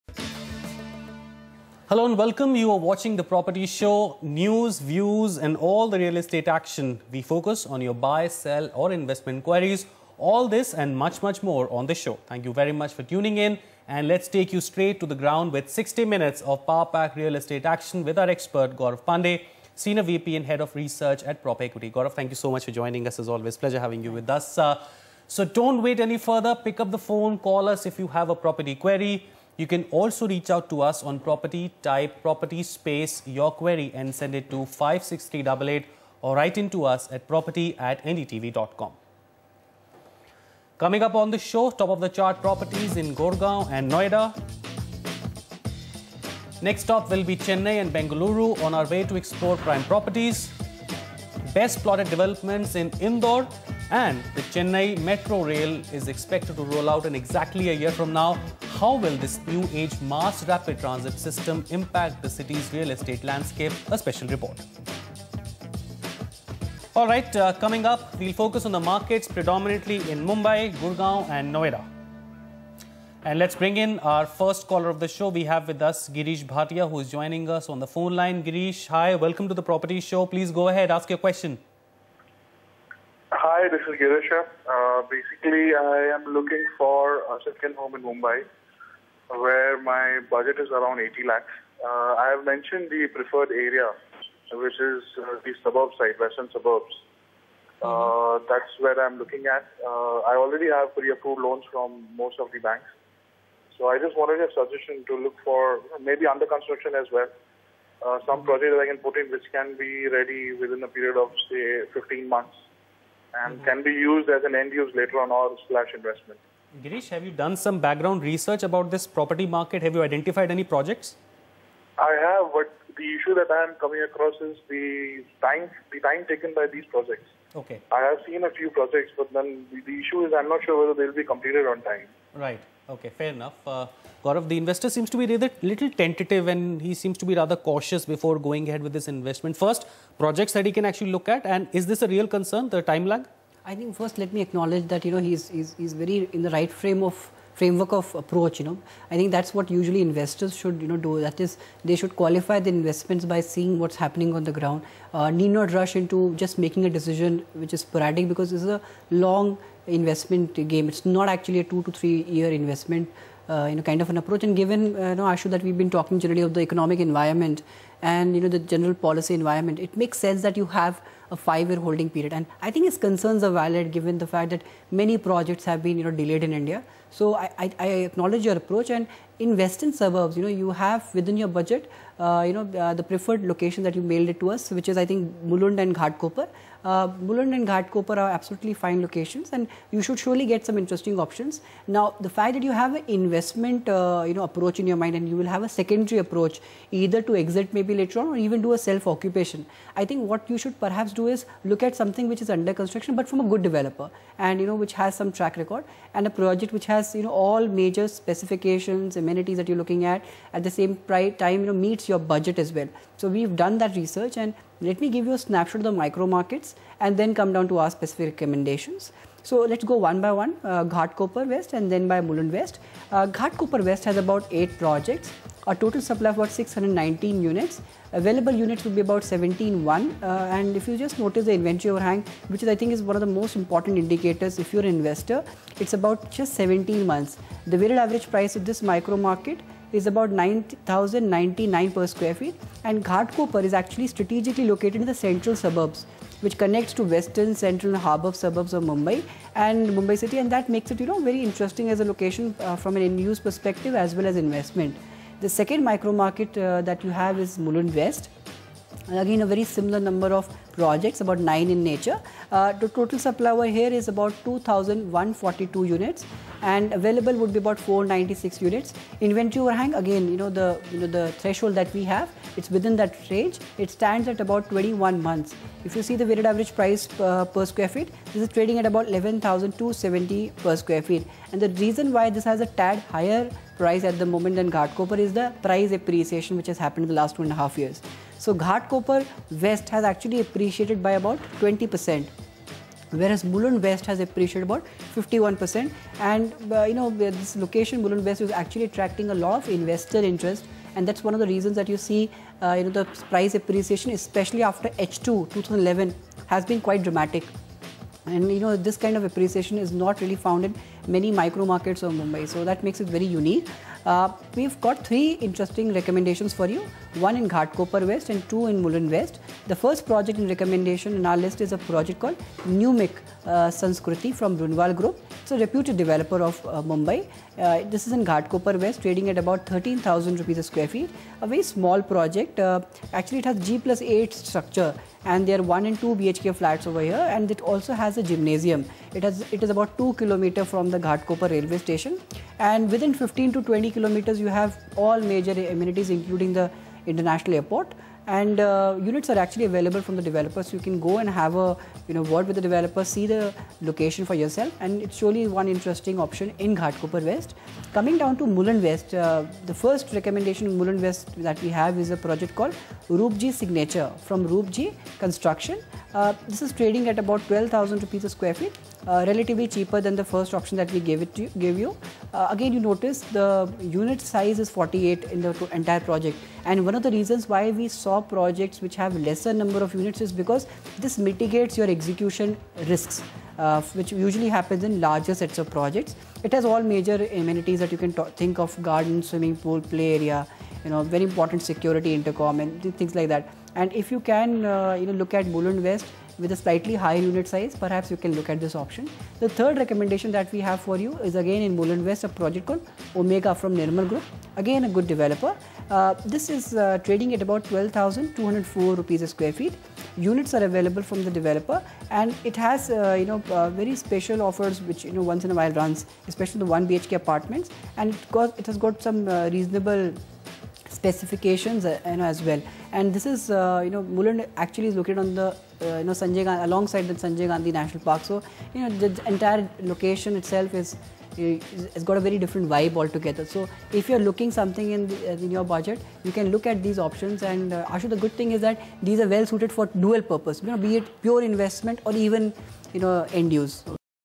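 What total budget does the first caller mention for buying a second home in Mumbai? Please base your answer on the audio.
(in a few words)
80 lakhs.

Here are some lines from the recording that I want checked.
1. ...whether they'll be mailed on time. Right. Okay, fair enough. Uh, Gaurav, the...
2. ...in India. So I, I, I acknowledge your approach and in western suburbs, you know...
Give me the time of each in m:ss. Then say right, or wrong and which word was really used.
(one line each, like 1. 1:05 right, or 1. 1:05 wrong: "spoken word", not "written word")
1. 2:10 wrong: "completed", not "mailed"
2. 2:56 right.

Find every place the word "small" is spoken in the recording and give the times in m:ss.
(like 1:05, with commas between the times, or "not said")
5:31.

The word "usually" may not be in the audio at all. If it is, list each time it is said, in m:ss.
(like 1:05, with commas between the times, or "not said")
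2:29, 6:24.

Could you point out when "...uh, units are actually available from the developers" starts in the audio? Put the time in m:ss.
5:48.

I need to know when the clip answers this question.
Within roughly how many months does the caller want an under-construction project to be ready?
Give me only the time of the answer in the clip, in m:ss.
1:51.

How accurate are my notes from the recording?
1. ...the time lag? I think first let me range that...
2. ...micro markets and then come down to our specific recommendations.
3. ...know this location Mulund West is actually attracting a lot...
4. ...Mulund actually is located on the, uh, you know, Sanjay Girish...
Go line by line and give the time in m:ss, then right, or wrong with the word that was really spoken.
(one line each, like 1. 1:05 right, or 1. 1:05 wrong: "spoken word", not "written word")
1. 2:22 wrong: "acknowledge", not "range"
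2. 3:36 right
3. 4:56 right
4. 7:04 wrong: "Gandhi", not "Girish".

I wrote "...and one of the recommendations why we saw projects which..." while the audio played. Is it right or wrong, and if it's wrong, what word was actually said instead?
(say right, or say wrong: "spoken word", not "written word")
wrong: "reasons", not "recommendations".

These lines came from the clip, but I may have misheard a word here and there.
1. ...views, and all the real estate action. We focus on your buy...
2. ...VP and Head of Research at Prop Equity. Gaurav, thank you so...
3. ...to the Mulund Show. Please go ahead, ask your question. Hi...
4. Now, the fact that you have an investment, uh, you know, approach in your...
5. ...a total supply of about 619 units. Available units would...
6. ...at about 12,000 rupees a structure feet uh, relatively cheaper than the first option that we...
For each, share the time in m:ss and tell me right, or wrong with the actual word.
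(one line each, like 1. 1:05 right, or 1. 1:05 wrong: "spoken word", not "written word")
1. 0:04 right
2. 0:20 right
3. 1:19 wrong: "Property", not "Mulund"
4. 3:11 right
5. 3:45 right
6. 6:07 wrong: "square", not "structure".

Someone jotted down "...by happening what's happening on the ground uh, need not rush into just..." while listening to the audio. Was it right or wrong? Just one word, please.
wrong.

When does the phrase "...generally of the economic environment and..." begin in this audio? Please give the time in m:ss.
2:46.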